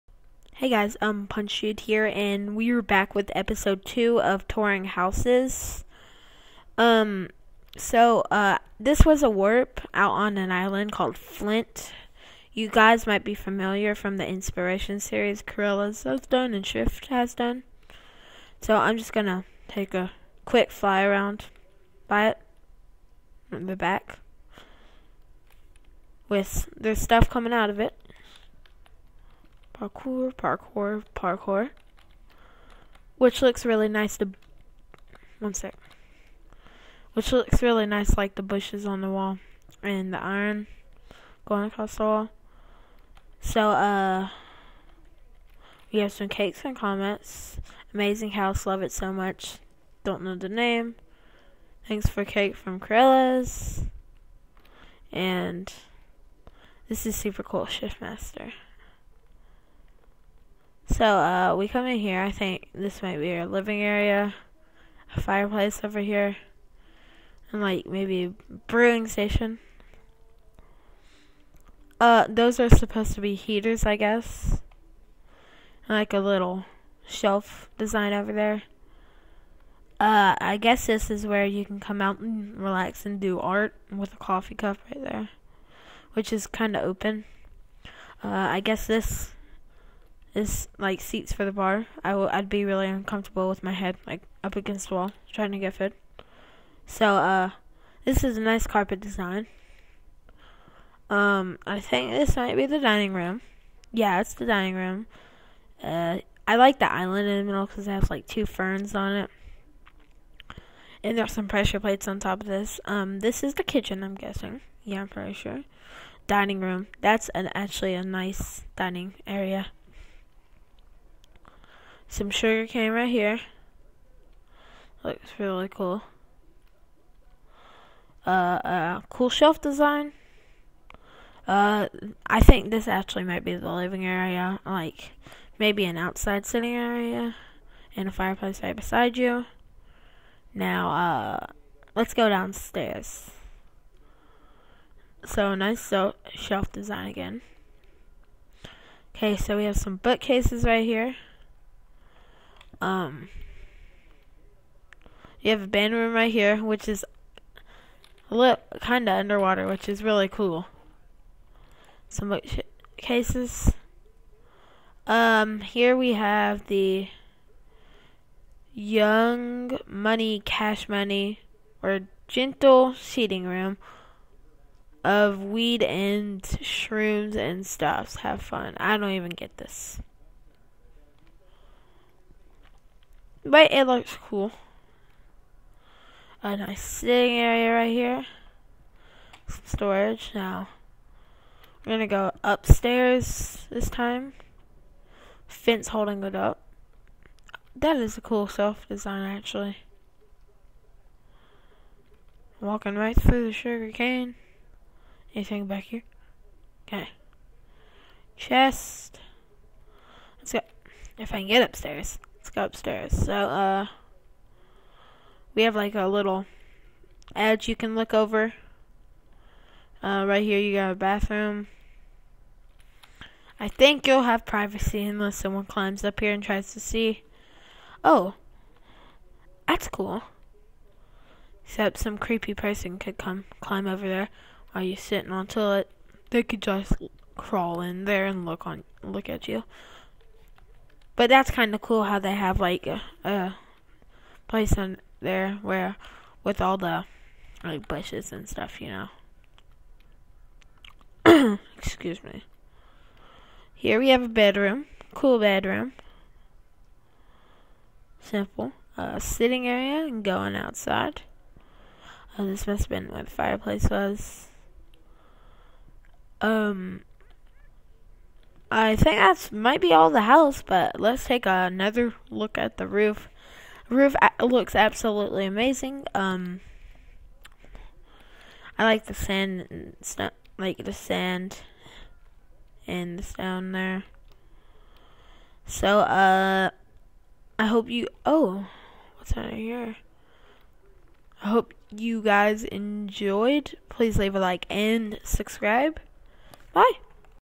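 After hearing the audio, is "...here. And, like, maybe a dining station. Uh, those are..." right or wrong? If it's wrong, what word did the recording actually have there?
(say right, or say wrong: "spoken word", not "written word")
wrong: "brewing", not "dining".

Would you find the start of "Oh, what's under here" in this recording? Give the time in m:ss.
4:48.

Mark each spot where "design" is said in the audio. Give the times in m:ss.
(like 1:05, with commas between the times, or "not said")
1:17, 1:38, 2:09, 2:26, 3:18.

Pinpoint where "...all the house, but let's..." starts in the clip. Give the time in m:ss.
4:29.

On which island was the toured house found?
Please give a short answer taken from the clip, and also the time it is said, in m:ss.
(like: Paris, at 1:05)
Flint, at 0:11.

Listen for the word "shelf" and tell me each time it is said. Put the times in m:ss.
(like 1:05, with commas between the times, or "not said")
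1:17, 2:09, 2:26.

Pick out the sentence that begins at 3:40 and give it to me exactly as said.
Uh, right here, you got a bathroom.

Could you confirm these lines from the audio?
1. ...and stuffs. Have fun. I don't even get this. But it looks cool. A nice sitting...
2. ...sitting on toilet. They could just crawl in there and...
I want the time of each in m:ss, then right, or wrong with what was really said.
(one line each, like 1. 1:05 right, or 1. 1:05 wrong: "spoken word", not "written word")
1. 2:57 right
2. 3:54 right.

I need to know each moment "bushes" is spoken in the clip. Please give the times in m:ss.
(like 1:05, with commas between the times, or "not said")
0:38, 4:07.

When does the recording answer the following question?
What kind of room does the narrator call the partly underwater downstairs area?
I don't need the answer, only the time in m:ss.
2:35.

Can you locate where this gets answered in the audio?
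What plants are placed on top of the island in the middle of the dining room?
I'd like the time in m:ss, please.
1:48.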